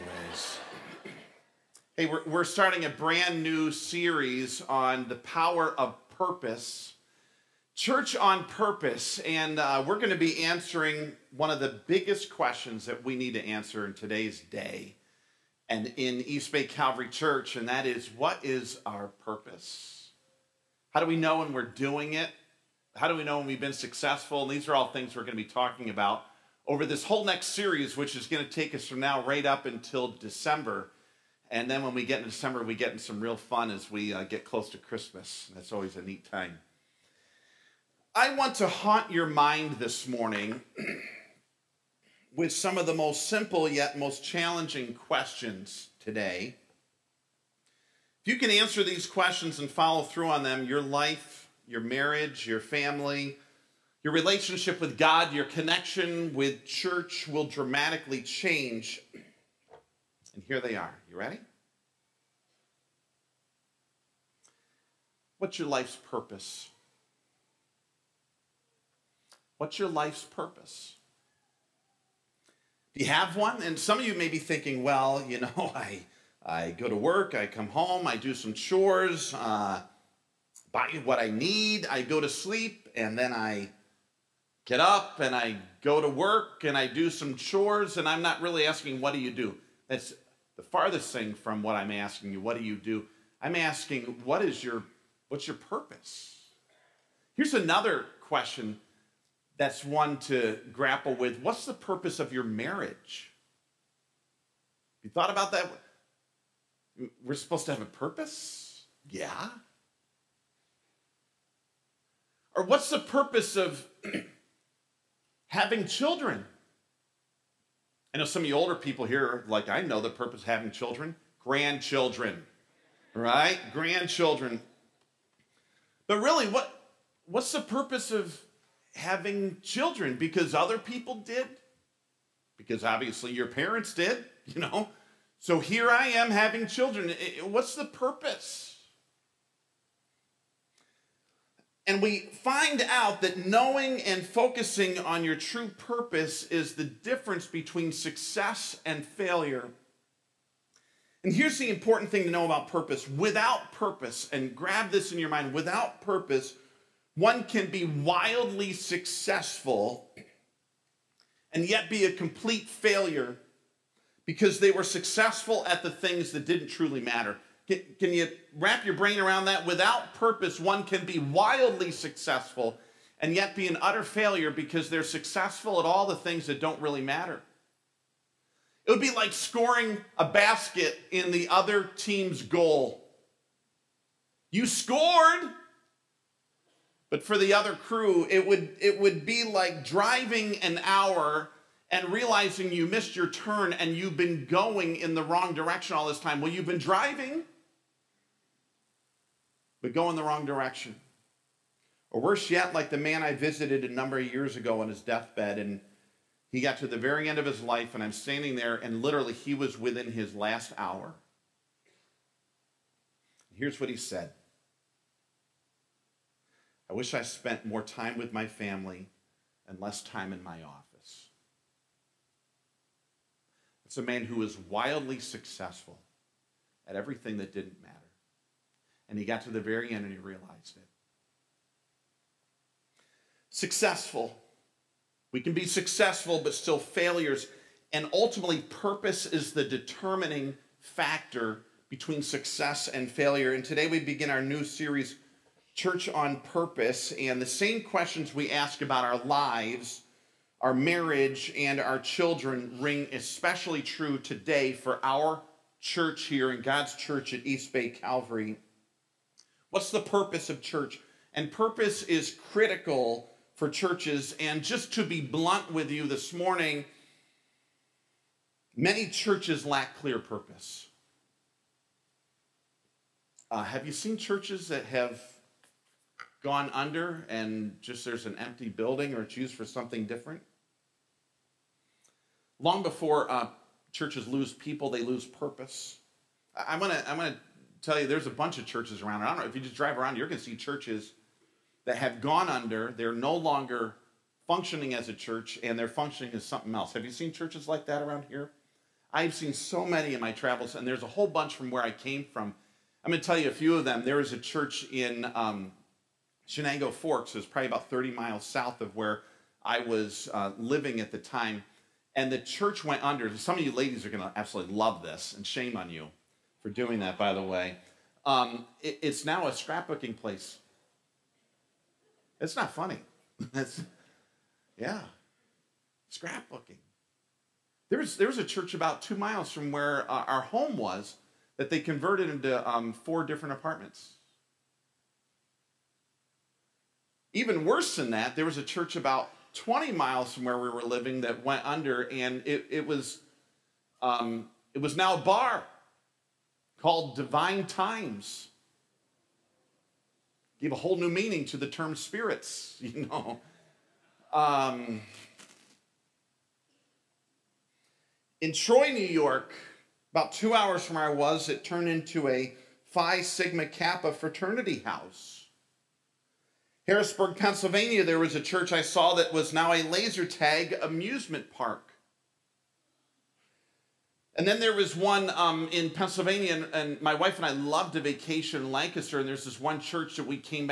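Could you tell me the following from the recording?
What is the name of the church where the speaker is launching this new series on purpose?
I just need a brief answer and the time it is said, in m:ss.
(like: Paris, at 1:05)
East Bay Calvary Church, at 0:16.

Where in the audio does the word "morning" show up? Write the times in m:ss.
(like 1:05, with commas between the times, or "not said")
0:40, 4:26.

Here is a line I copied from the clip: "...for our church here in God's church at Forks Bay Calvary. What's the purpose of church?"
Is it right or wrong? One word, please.
wrong.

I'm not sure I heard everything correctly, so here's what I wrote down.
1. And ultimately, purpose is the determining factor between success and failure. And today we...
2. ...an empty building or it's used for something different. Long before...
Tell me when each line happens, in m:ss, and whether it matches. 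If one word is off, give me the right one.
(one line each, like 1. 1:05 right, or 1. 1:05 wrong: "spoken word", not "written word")
1. 3:57 right
2. 4:38 right.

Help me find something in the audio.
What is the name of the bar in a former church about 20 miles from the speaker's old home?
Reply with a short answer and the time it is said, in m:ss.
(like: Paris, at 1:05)
Divine Times, at 5:47.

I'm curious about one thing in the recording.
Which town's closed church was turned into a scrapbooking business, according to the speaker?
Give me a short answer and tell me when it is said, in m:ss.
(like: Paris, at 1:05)
Chenango Forks, at 5:06.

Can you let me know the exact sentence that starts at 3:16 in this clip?
Well, you've been driving, but going the wrong direction.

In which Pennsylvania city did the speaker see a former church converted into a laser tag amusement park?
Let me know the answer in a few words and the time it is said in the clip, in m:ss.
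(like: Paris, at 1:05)
Harrisburg, at 6:06.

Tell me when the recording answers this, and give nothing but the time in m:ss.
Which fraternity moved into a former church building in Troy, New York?
6:02.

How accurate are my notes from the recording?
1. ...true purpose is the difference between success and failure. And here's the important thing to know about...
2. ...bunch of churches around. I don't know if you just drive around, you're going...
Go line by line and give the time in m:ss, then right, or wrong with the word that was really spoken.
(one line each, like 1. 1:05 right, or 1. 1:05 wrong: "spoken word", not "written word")
1. 2:25 right
2. 4:48 right.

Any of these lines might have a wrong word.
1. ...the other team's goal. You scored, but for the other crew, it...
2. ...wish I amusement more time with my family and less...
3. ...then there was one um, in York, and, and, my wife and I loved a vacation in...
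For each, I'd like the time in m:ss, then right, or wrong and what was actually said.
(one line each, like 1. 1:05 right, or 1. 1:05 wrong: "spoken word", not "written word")
1. 3:01 right
2. 3:36 wrong: "spent", not "amusement"
3. 6:14 wrong: "Pennsylvania", not "York".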